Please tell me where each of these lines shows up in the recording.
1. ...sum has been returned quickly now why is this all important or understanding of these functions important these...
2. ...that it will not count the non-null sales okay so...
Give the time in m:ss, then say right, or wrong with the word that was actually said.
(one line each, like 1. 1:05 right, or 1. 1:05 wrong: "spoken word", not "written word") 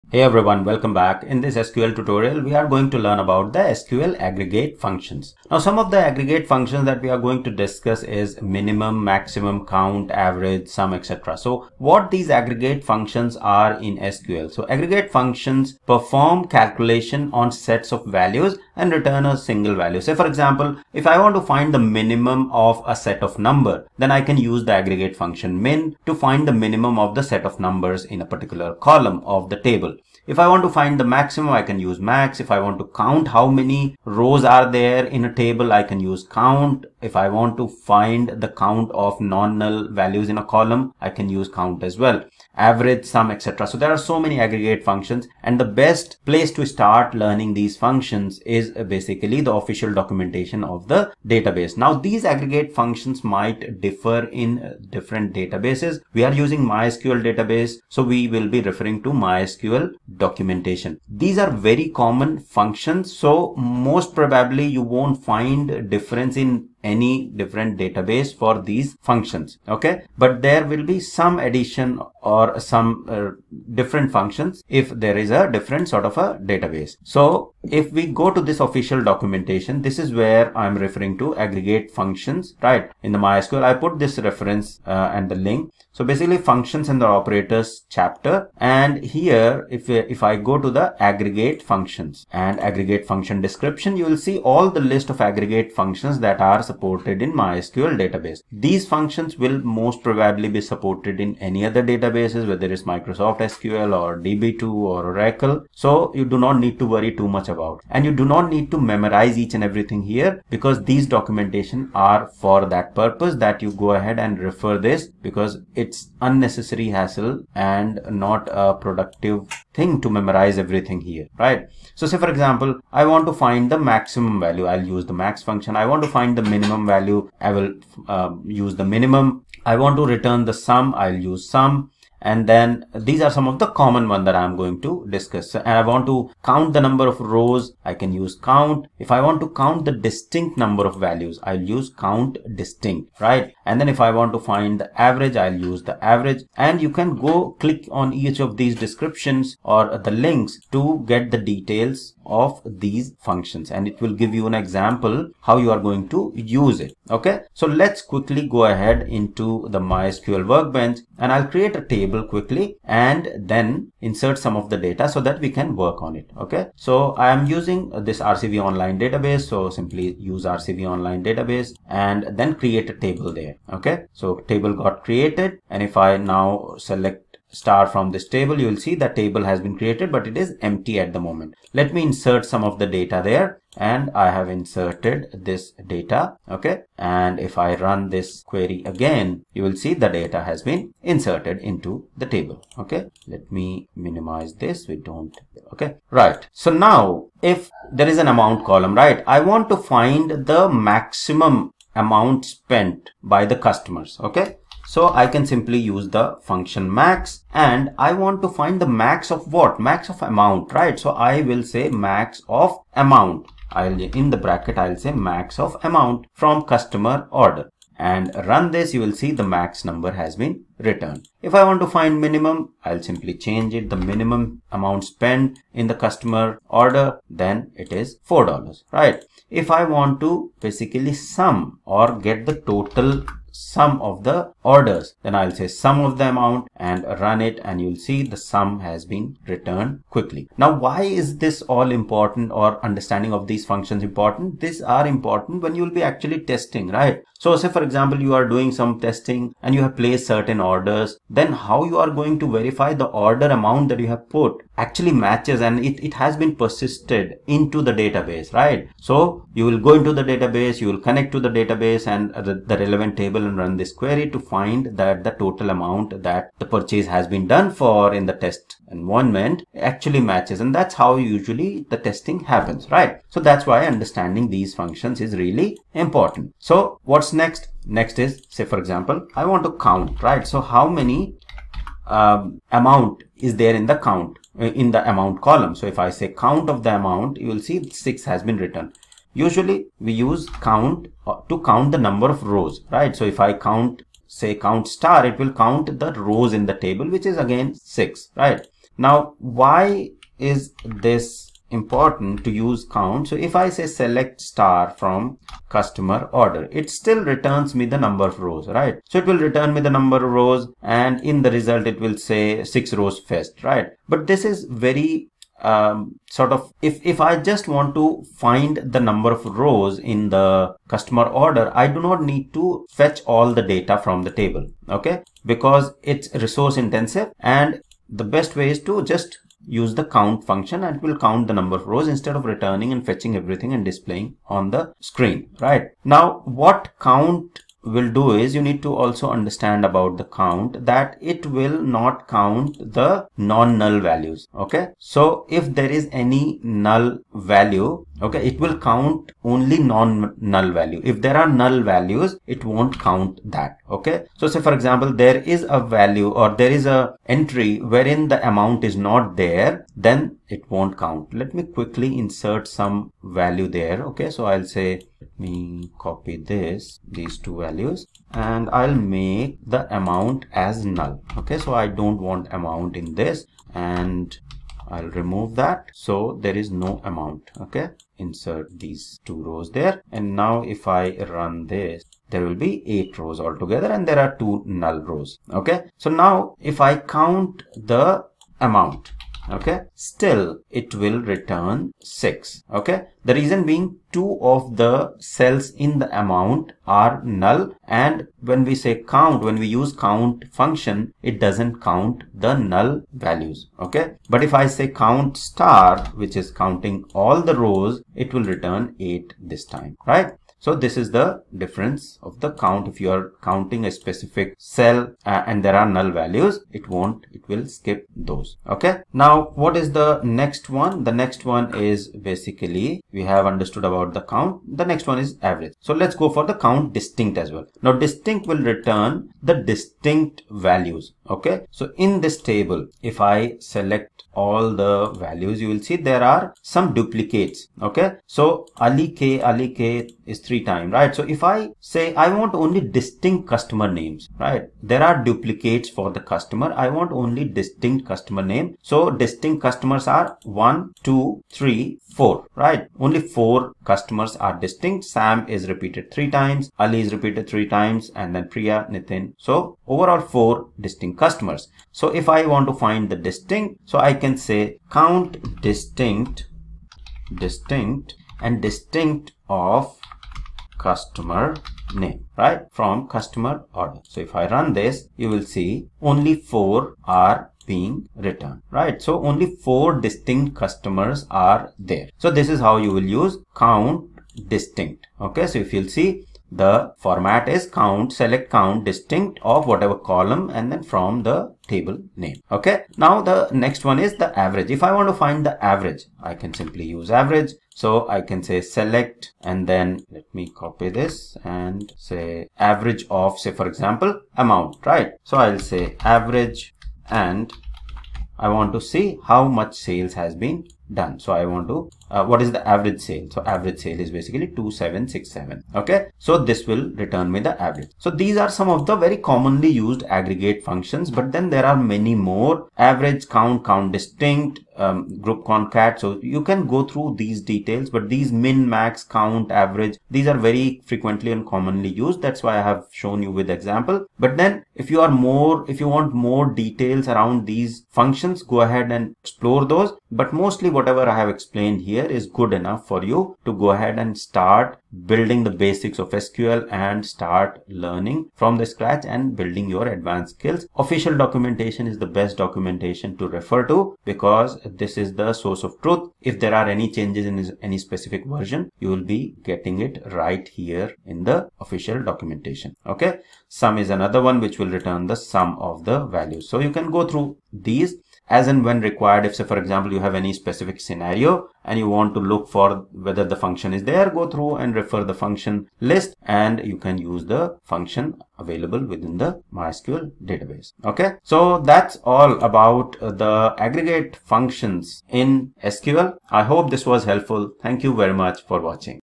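1. 3:58 right
2. 5:40 wrong: "values", not "sales".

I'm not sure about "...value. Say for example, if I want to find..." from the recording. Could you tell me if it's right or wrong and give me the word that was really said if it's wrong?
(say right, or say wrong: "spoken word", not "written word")
right.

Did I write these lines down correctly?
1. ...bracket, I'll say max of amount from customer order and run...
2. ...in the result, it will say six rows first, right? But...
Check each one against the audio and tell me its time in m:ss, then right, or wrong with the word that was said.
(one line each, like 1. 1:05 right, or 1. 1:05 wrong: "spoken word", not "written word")
1. 3:34 right
2. 5:11 right.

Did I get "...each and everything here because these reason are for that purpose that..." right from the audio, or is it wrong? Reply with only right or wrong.
wrong.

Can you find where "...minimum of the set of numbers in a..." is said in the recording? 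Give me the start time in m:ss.
0:26.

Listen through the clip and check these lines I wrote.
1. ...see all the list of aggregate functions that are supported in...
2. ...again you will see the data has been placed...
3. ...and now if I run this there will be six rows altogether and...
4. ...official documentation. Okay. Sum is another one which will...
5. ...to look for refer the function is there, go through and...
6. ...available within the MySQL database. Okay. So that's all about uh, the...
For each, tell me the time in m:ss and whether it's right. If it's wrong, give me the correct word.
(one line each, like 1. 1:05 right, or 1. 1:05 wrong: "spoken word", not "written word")
1. 1:34 right
2. 3:08 wrong: "inserted", not "placed"
3. 6:20 wrong: "eight", not "six"
4. 9:21 right
5. 9:32 wrong: "whether", not "refer"
6. 9:38 right.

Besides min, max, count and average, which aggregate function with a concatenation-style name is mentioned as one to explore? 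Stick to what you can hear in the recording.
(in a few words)
group concat.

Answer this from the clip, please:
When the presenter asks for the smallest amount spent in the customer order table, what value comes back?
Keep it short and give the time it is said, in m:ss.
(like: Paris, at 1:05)
$4, at 3:47.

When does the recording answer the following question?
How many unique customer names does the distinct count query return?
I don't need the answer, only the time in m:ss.
7:56.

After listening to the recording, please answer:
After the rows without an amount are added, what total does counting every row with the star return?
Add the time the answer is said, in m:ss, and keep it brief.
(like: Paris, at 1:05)
8, at 6:48.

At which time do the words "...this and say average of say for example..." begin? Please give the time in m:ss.
8:20.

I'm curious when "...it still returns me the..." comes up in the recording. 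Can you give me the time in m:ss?
5:06.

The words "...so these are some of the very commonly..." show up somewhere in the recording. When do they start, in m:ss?
8:37.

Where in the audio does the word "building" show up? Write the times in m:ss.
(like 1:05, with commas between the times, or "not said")
9:05, 9:09.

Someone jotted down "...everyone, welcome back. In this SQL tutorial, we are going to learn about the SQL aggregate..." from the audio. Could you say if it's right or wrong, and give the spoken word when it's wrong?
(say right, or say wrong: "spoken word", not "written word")
right.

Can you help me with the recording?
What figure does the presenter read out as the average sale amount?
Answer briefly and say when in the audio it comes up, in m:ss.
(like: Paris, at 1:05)
2767, at 8:33.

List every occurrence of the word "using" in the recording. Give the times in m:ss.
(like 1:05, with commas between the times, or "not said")
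0:56, 2:47.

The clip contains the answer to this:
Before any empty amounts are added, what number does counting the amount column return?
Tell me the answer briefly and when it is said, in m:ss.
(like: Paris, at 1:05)
6, at 4:47.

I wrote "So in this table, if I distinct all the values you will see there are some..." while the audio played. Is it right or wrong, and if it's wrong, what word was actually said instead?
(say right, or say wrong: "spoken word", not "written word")
wrong: "select", not "distinct".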